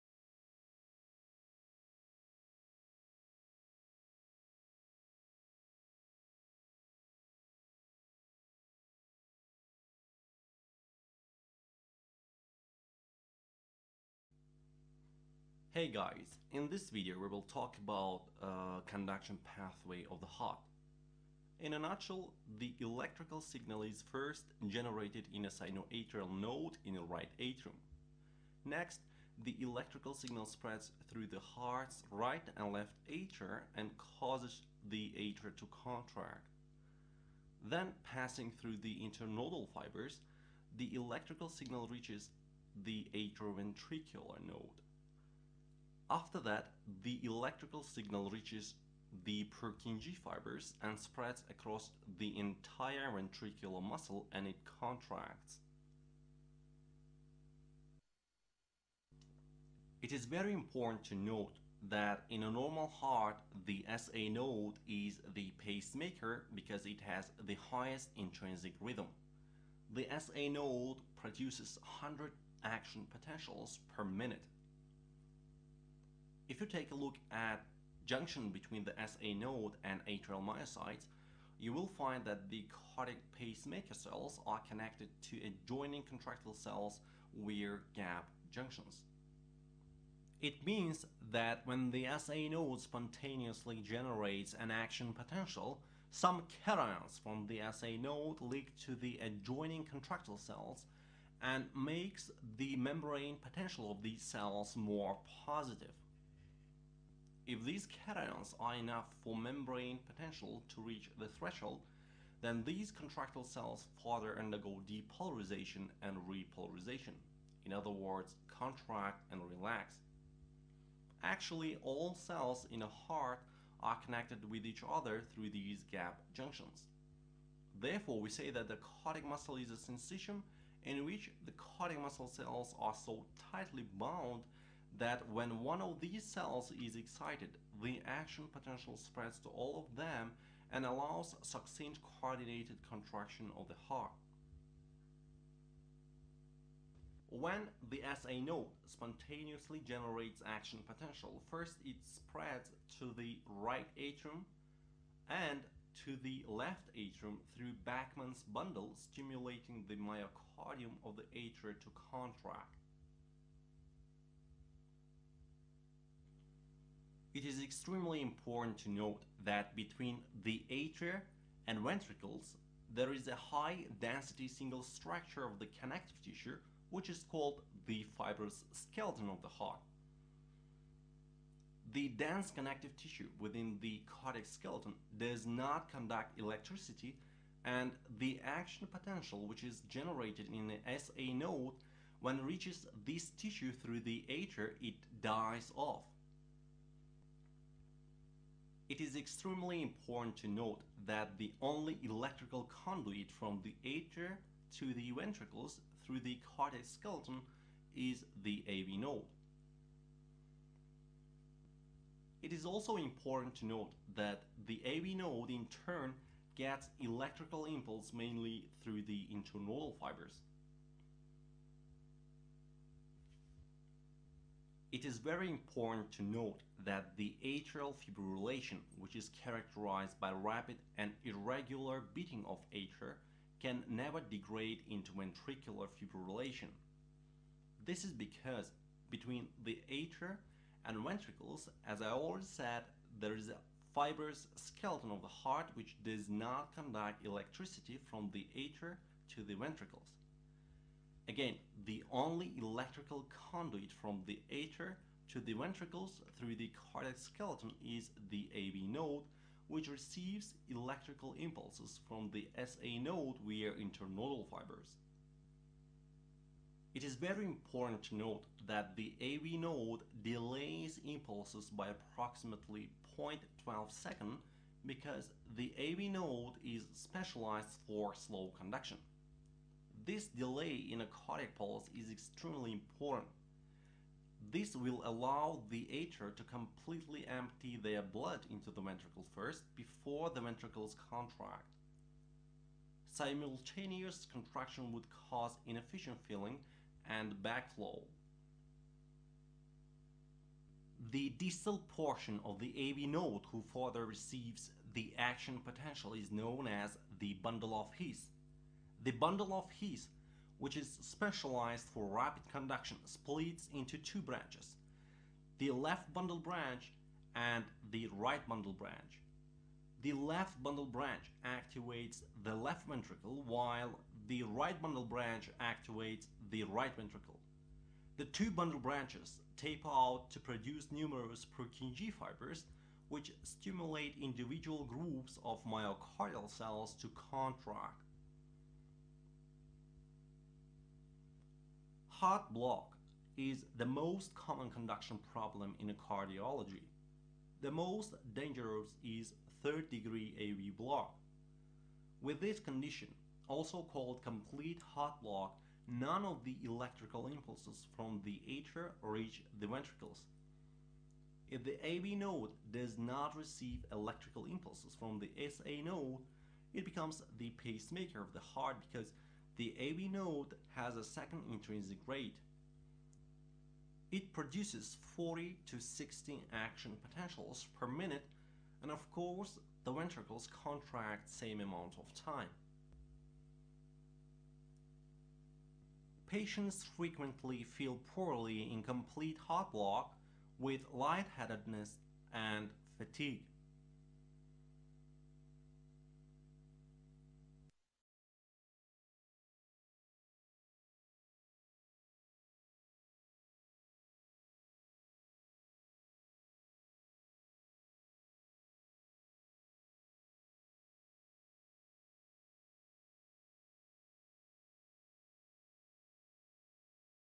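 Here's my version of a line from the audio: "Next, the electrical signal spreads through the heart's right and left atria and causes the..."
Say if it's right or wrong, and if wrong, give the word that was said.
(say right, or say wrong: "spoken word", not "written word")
right.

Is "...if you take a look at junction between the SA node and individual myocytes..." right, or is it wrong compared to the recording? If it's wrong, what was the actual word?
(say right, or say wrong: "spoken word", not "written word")
wrong: "atrial", not "individual".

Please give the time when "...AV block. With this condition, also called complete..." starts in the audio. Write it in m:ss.
5:50.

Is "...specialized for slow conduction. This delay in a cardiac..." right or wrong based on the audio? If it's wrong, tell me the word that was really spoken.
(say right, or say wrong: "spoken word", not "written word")
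right.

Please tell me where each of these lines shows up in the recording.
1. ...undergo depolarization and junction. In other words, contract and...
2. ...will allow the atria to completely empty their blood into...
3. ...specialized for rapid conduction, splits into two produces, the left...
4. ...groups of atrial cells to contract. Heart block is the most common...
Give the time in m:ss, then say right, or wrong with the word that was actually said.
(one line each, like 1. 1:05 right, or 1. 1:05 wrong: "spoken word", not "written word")
1. 1:54 wrong: "repolarization", not "junction"
2. 4:44 right
3. 5:11 wrong: "branches", not "produces"
4. 5:34 wrong: "myocardial", not "atrial".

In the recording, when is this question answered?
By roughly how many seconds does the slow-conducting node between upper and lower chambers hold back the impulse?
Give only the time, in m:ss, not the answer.
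4:33.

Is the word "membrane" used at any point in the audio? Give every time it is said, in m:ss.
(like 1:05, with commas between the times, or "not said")
1:42, 1:49.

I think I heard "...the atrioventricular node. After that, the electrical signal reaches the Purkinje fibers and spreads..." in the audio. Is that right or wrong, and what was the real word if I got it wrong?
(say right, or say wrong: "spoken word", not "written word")
right.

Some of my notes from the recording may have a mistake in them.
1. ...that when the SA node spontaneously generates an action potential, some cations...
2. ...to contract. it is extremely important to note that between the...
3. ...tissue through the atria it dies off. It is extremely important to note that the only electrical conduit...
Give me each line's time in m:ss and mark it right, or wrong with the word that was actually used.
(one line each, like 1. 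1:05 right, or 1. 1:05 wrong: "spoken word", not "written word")
1. 1:31 right
2. 2:41 right
3. 3:13 right.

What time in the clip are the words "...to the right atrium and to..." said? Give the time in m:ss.
2:32.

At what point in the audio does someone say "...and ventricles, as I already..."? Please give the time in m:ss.
4:00.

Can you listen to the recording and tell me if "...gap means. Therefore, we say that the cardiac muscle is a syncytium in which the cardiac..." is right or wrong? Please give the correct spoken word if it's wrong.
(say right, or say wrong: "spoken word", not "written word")
wrong: "junctions", not "means".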